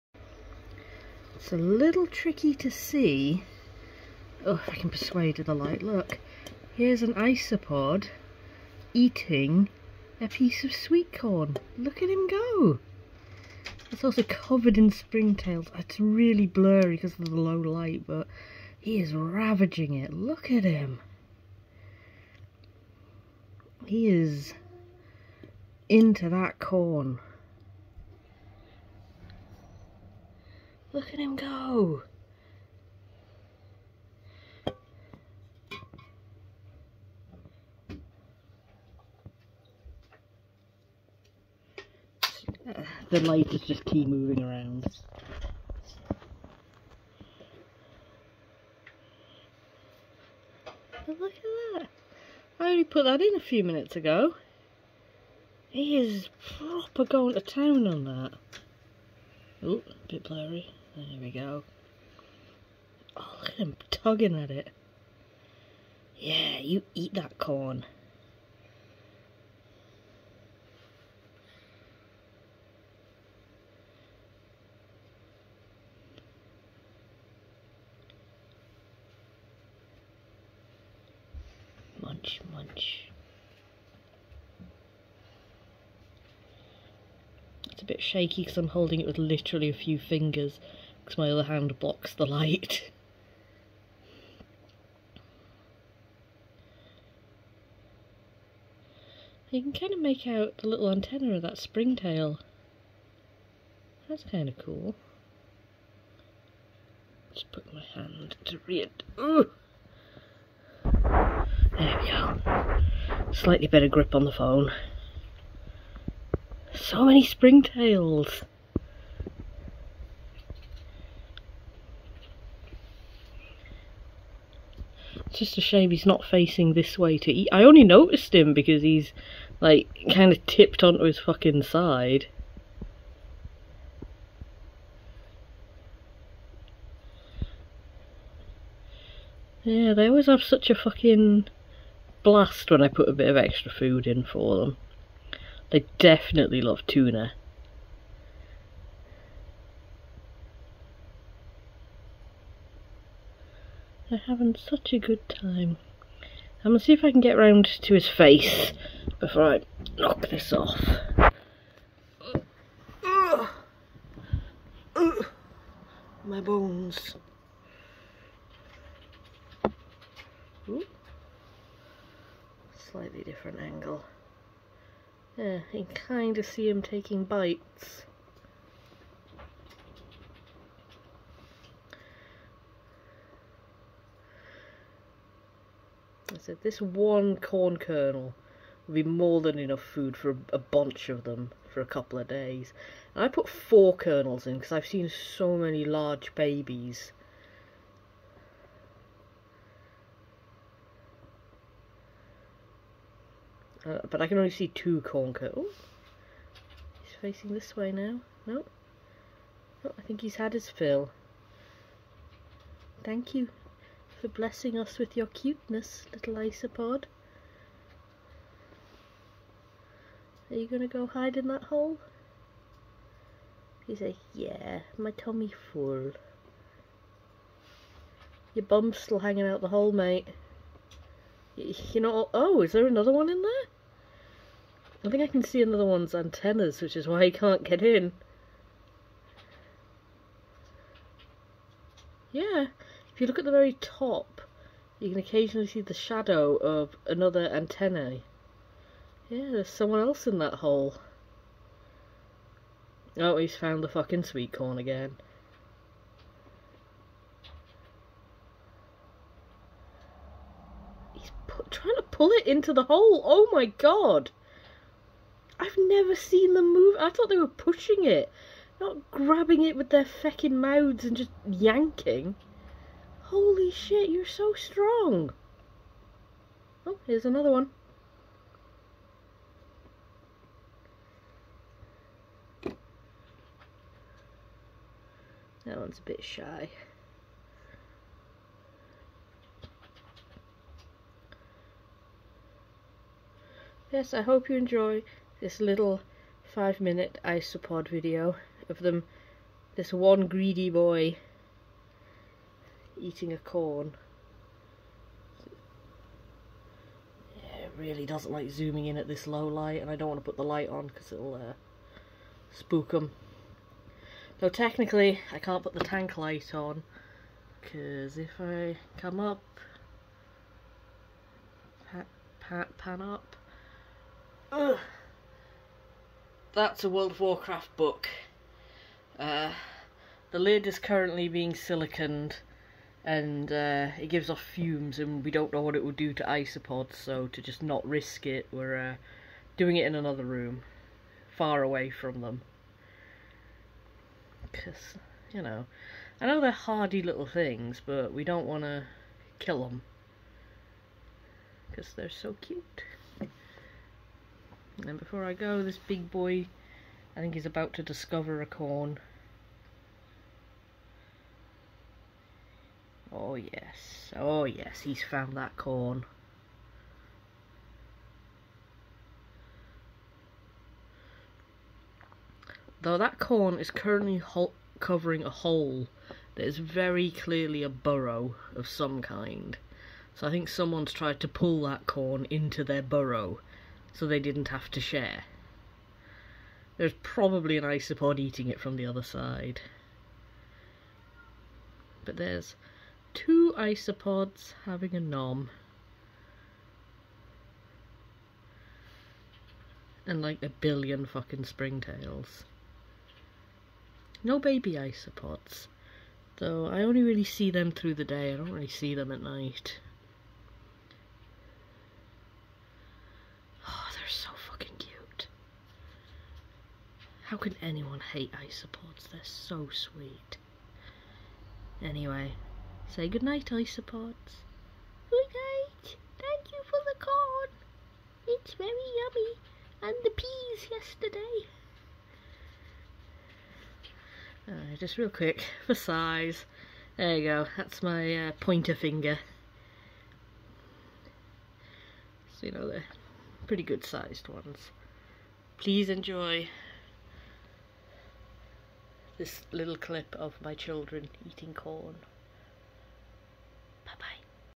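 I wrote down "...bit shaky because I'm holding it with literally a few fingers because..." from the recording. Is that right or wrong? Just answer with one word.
right.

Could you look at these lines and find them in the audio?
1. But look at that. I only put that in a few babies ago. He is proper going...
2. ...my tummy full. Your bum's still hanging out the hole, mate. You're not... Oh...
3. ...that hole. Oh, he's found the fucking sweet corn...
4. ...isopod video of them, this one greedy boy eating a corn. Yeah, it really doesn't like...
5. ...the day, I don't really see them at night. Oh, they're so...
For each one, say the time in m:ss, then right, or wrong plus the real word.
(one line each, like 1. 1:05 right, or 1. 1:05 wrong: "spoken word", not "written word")
1. 0:51 wrong: "minutes", not "babies"
2. 3:44 right
3. 4:10 right
4. 4:57 right
5. 6:47 right.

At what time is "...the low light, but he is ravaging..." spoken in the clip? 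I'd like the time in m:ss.
0:17.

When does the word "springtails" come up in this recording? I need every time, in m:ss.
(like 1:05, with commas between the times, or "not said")
0:14, 1:41, 1:57, 6:41.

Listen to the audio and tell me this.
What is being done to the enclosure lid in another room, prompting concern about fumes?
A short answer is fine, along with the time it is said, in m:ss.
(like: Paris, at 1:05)
siliconed, at 5:31.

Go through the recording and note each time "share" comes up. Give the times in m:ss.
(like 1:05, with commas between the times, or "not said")
6:24.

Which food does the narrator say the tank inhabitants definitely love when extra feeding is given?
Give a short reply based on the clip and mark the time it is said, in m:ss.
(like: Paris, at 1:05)
tuna, at 2:26.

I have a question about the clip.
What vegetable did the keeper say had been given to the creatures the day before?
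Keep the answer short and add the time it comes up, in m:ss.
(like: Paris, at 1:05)
peas, at 7:10.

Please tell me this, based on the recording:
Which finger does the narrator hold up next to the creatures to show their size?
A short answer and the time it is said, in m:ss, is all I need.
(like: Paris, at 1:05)
pointer finger, at 7:18.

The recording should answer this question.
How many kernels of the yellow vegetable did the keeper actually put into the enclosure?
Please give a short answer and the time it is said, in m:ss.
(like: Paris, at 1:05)
4, at 3:13.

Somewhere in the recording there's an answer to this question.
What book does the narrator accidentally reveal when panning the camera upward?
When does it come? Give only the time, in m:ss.
5:26.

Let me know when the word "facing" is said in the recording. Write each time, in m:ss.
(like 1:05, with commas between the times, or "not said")
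2:06, 3:27.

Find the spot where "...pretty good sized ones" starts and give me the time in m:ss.
7:23.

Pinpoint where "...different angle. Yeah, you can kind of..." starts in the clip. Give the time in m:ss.
2:53.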